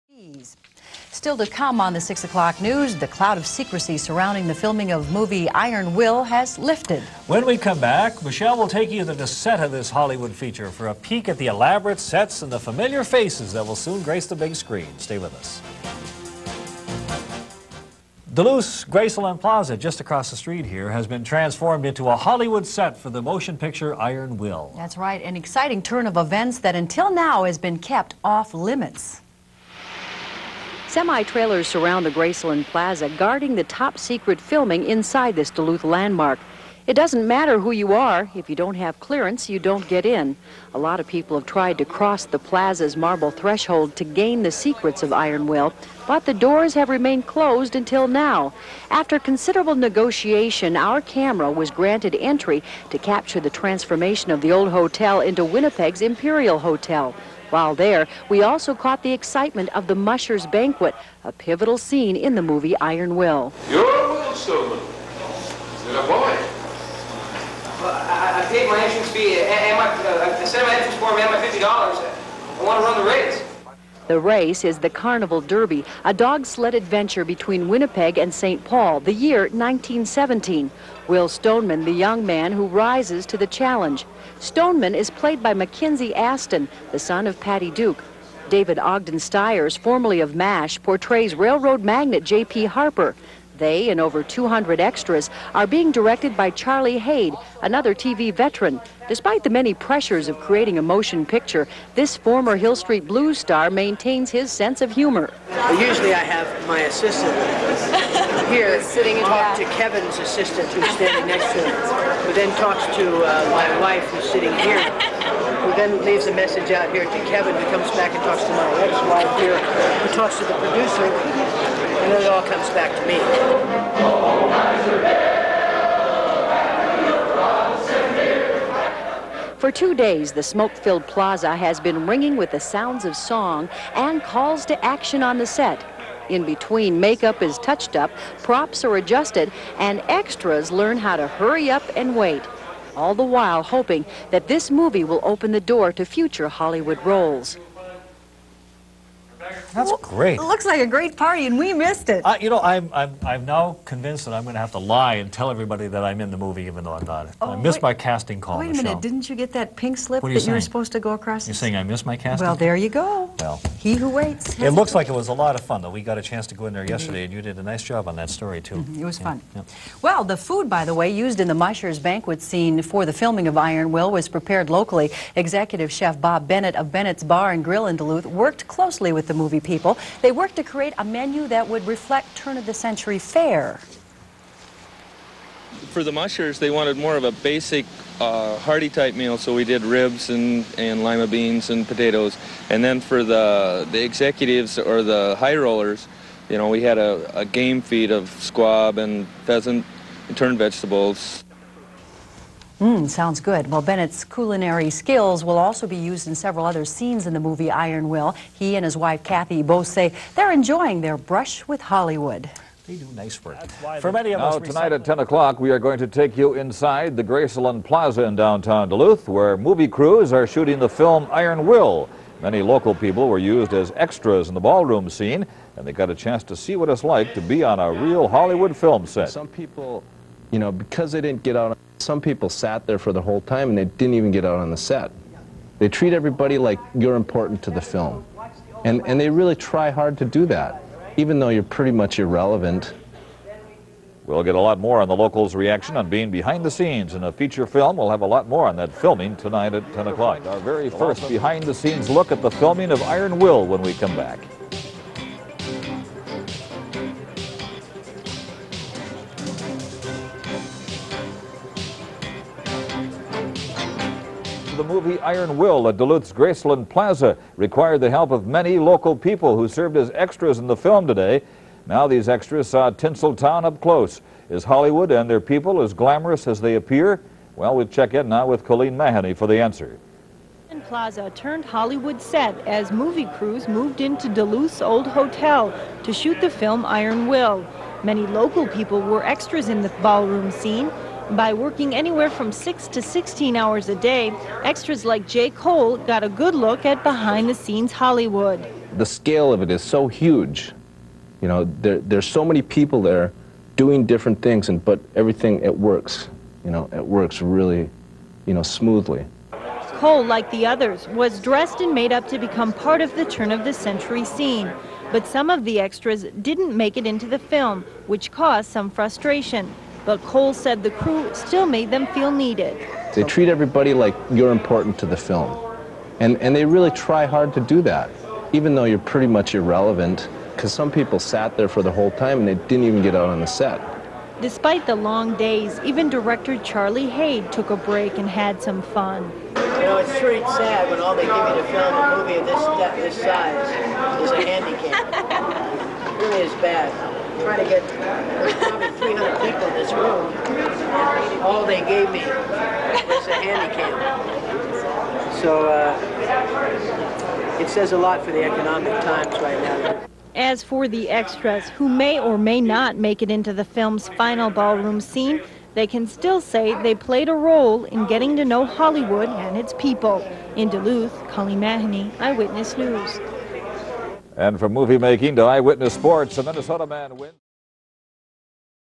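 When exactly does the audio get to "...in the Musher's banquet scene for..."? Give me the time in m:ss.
2:51.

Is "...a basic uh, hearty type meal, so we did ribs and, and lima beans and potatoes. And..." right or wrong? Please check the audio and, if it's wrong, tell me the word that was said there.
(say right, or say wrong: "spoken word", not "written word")
right.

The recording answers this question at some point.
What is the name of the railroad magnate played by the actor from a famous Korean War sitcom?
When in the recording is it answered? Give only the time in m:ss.
1:32.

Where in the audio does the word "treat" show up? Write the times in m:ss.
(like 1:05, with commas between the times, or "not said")
3:55, 5:23.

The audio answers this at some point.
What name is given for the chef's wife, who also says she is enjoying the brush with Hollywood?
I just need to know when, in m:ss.
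3:29.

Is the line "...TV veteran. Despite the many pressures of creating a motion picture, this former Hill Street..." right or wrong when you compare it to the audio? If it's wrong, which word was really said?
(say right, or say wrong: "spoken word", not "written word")
right.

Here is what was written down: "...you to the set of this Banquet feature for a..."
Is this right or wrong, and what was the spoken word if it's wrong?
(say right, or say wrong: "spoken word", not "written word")
wrong: "Hollywood", not "Banquet".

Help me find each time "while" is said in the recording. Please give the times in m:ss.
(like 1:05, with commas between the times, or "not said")
0:57, 2:23.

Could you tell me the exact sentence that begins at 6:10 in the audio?
In Duluth, Colleen Mahoney, Eyewitness News.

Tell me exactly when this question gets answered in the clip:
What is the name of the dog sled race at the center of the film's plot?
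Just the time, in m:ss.
1:14.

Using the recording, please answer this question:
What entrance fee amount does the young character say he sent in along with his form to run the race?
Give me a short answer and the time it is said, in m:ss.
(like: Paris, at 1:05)
$50, at 1:11.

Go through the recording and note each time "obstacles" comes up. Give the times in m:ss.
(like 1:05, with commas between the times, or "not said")
not said.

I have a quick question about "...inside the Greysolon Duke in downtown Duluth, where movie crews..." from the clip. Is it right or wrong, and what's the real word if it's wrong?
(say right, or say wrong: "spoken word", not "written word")
wrong: "Plaza", not "Duke".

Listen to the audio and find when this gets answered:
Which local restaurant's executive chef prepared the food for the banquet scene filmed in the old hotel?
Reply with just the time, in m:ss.
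2:56.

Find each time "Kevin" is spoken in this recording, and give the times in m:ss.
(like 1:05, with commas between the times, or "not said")
1:49, 1:57.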